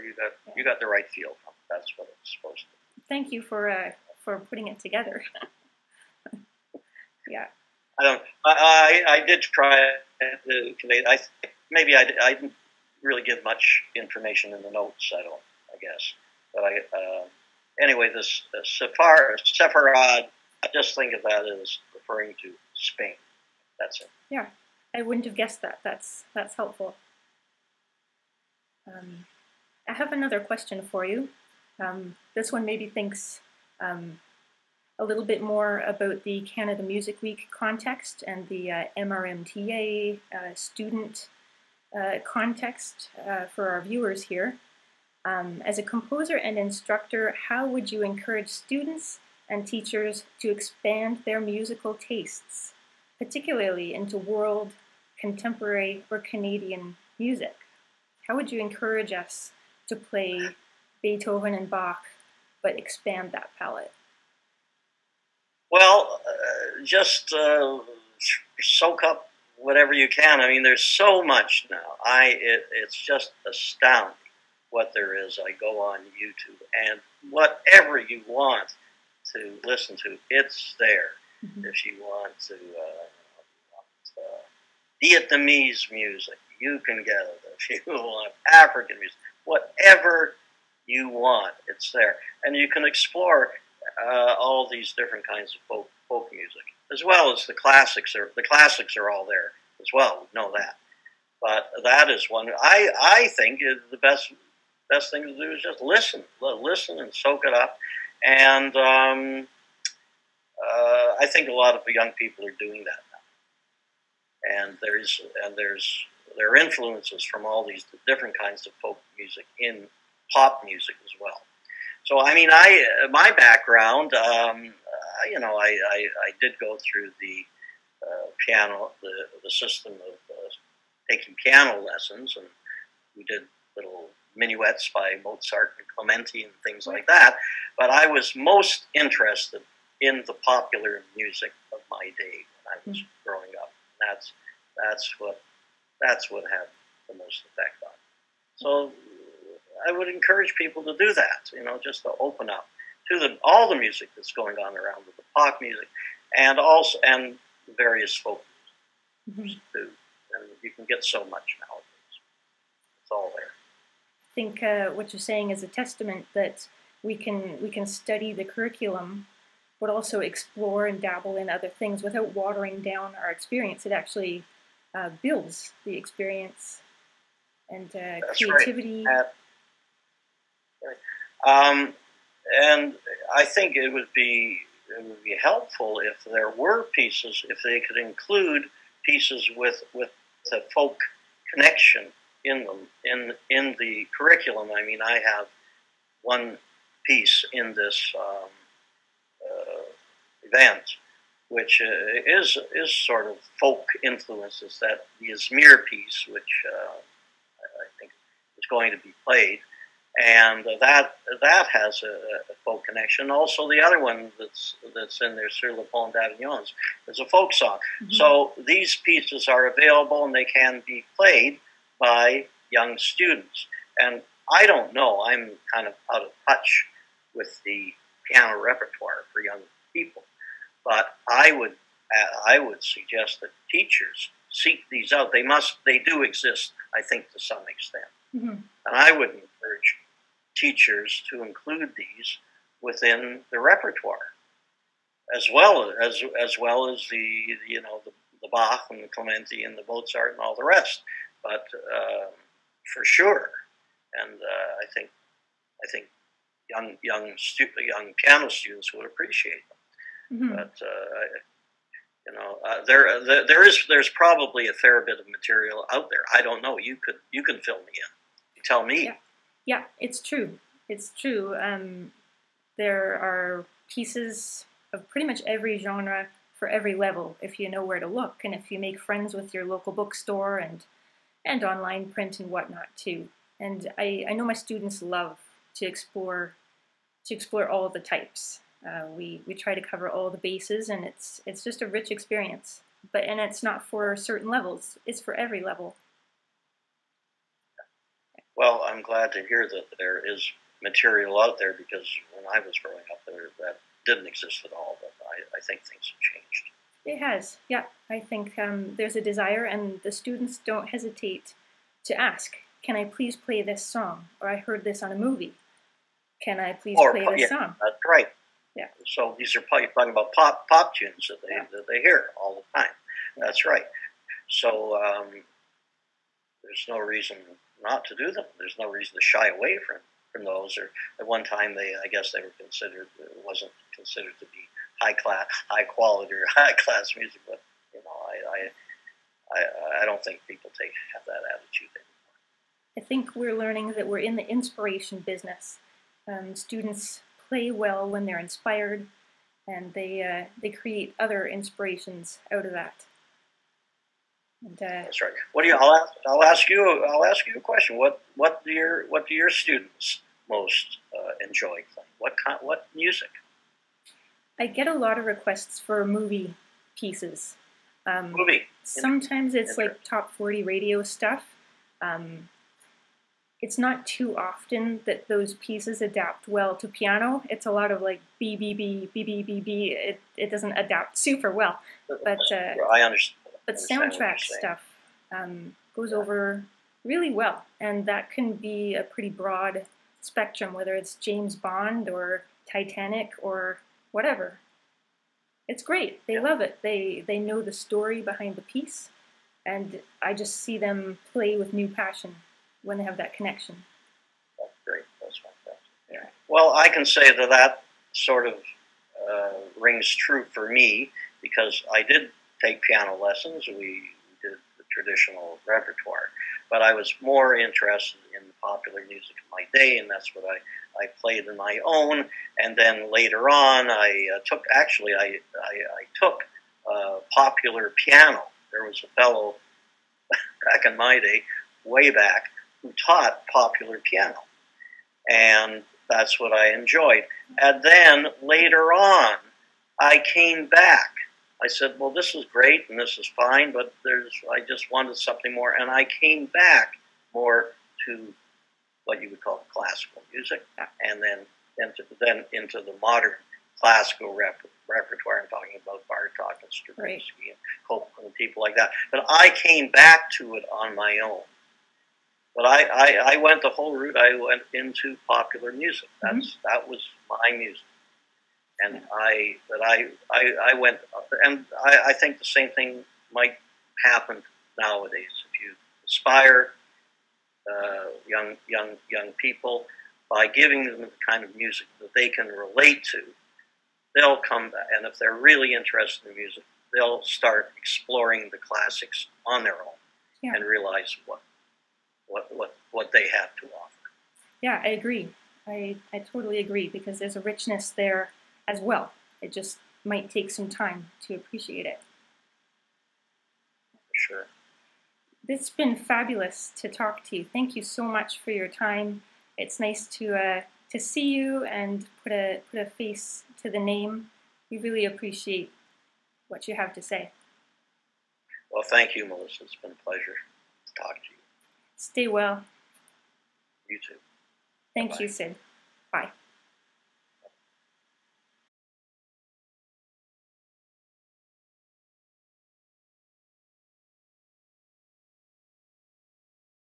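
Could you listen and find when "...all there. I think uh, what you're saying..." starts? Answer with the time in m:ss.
2:43.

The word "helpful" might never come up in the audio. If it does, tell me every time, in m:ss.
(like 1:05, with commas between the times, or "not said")
0:26, 3:05.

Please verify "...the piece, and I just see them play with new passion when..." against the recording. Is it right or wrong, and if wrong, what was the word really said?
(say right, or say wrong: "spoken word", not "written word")
right.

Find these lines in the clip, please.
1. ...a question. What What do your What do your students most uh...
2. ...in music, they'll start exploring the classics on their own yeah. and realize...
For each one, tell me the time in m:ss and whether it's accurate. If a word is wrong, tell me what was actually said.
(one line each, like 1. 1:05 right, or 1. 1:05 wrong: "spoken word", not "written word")
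1. 5:57 right
2. 8:06 right.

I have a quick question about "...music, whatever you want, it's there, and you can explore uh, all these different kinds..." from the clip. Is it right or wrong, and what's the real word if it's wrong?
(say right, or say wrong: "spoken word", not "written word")
right.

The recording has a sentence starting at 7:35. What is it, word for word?
I'm talking about Bartok and Stravinsky right.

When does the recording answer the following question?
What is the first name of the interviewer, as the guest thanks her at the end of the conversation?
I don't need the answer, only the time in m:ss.
8:39.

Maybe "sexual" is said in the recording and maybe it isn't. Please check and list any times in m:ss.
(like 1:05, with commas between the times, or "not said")
not said.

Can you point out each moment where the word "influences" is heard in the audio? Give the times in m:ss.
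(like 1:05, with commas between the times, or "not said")
1:56, 3:24.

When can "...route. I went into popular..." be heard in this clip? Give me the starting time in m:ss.
7:43.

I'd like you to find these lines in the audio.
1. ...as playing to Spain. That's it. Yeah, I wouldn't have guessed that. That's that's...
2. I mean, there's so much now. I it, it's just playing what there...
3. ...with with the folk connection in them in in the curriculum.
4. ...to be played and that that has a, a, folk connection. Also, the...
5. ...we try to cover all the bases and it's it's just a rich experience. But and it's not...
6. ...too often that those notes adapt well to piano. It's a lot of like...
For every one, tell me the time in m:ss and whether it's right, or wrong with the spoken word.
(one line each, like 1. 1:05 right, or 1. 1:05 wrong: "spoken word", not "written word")
1. 0:21 wrong: "referring", not "playing"
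2. 1:10 wrong: "astounding", not "playing"
3. 3:09 right
4. 3:28 right
5. 4:49 right
6. 6:14 wrong: "pieces", not "notes".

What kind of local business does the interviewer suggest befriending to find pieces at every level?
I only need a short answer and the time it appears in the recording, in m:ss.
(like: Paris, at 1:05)
bookstore, at 4:39.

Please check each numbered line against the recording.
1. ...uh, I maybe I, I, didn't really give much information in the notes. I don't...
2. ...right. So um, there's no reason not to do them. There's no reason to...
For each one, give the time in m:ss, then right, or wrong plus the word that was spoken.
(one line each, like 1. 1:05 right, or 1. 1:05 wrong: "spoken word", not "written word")
1. 0:10 right
2. 5:23 right.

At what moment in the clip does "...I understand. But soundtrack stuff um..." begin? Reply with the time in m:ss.
6:22.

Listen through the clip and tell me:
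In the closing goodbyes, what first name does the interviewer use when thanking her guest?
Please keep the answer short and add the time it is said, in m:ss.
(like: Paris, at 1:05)
Sid, at 8:45.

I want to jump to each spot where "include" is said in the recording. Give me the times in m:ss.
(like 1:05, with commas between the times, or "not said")
3:07, 4:01.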